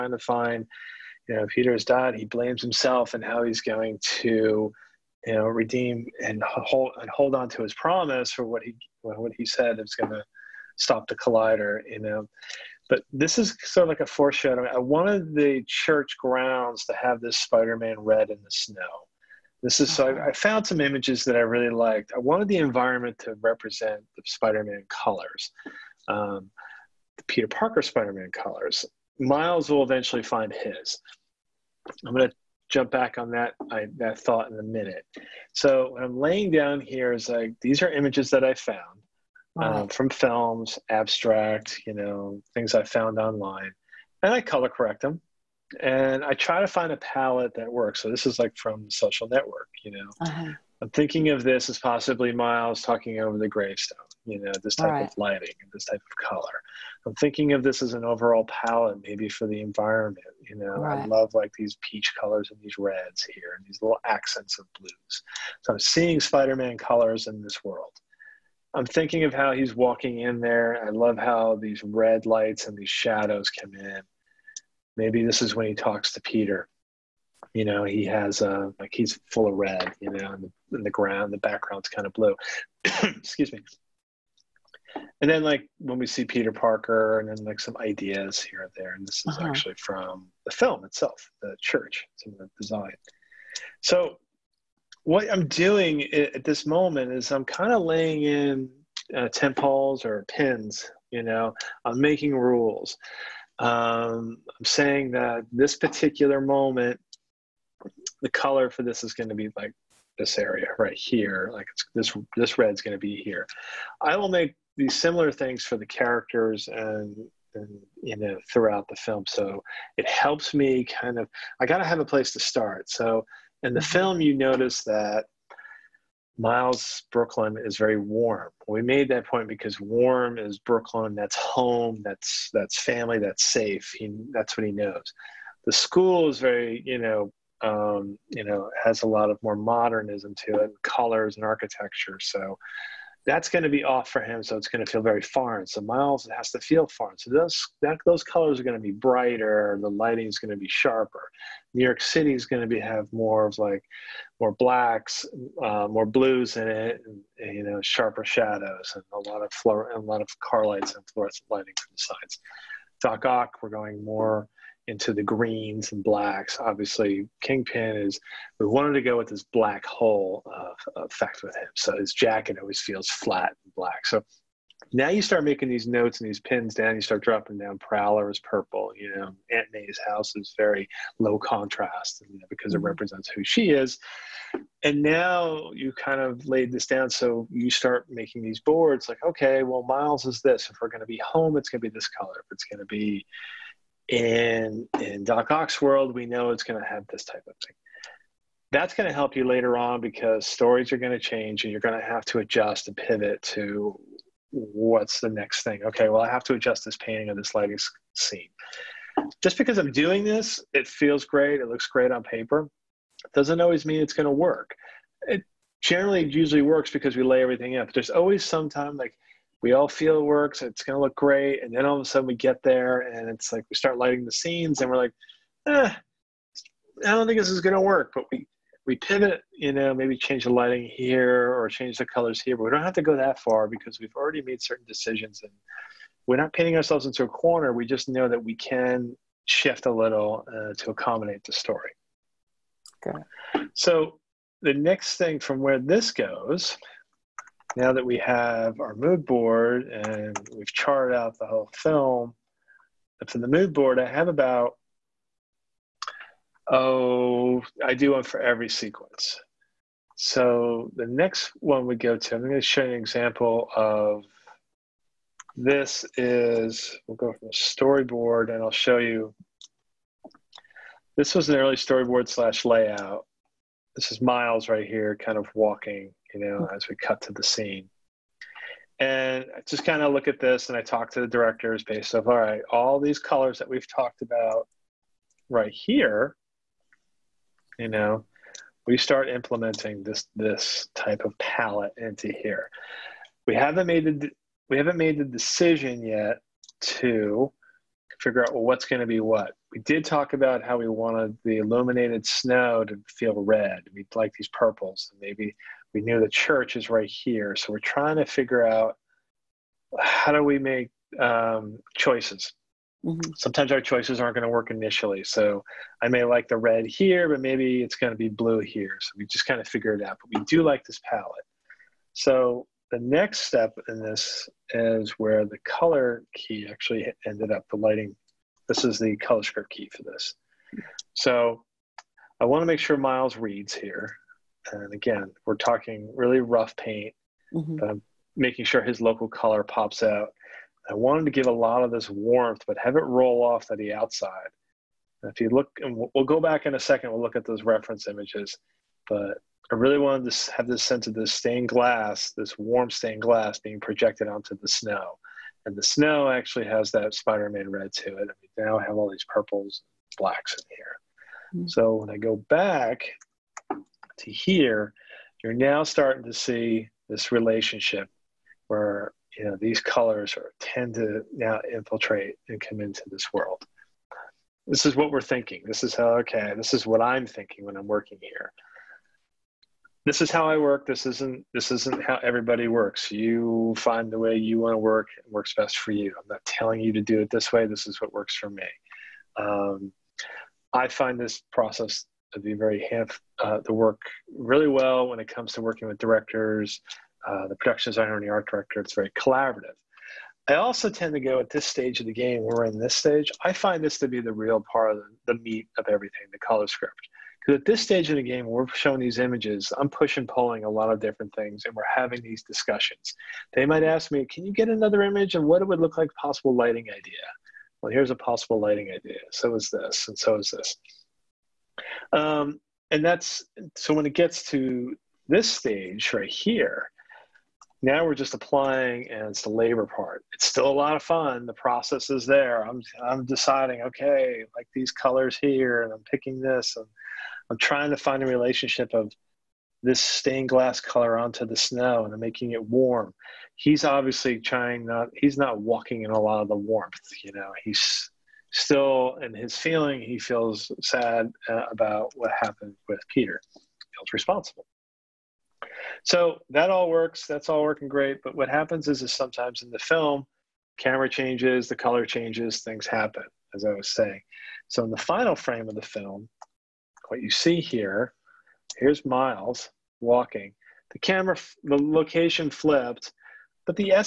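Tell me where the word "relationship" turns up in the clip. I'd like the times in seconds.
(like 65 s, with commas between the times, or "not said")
367 s, 438 s.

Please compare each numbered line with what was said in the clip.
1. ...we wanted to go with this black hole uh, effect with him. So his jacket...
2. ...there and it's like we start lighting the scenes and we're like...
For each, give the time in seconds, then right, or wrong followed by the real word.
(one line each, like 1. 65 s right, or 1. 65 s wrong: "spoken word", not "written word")
1. 168 s right
2. 222 s right.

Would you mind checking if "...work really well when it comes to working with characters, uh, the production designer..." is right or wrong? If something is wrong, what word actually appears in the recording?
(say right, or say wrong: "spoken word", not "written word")
wrong: "directors", not "characters".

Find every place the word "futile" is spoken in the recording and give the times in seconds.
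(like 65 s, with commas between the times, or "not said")
not said.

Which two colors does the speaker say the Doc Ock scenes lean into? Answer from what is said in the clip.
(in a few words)
Greens and blacks.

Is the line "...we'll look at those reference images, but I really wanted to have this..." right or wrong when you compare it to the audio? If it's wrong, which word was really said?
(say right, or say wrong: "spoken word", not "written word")
right.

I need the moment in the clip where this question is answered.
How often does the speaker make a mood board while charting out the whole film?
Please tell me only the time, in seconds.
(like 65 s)
258 s.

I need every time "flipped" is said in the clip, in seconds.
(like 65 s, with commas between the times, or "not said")
472 s.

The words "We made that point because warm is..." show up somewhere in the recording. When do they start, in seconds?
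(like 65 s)
128 s.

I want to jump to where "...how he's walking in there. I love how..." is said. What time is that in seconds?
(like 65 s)
69 s.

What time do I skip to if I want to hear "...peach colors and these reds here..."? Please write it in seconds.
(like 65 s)
61 s.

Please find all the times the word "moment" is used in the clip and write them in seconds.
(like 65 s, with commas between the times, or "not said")
96 s, 106 s.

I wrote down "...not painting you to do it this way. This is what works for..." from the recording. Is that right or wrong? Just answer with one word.
wrong.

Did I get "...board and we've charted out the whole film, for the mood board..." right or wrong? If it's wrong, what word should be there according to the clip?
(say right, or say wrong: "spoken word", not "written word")
right.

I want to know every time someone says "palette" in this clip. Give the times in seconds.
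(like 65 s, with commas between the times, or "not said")
46 s, 58 s, 291 s, 321 s.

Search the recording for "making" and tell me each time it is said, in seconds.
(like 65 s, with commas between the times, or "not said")
101 s, 175 s, 188 s, 338 s, 442 s.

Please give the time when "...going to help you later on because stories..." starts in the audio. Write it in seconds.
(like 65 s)
198 s.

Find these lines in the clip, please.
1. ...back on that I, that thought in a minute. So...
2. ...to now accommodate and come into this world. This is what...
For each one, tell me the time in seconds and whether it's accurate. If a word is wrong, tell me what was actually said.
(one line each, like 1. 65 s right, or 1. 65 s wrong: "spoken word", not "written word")
1. 32 s right
2. 370 s wrong: "infiltrate", not "accommodate".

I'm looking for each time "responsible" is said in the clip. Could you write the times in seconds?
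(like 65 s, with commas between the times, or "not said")
454 s.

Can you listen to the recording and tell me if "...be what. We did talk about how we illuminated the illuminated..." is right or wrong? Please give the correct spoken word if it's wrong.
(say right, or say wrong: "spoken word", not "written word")
wrong: "wanted", not "illuminated".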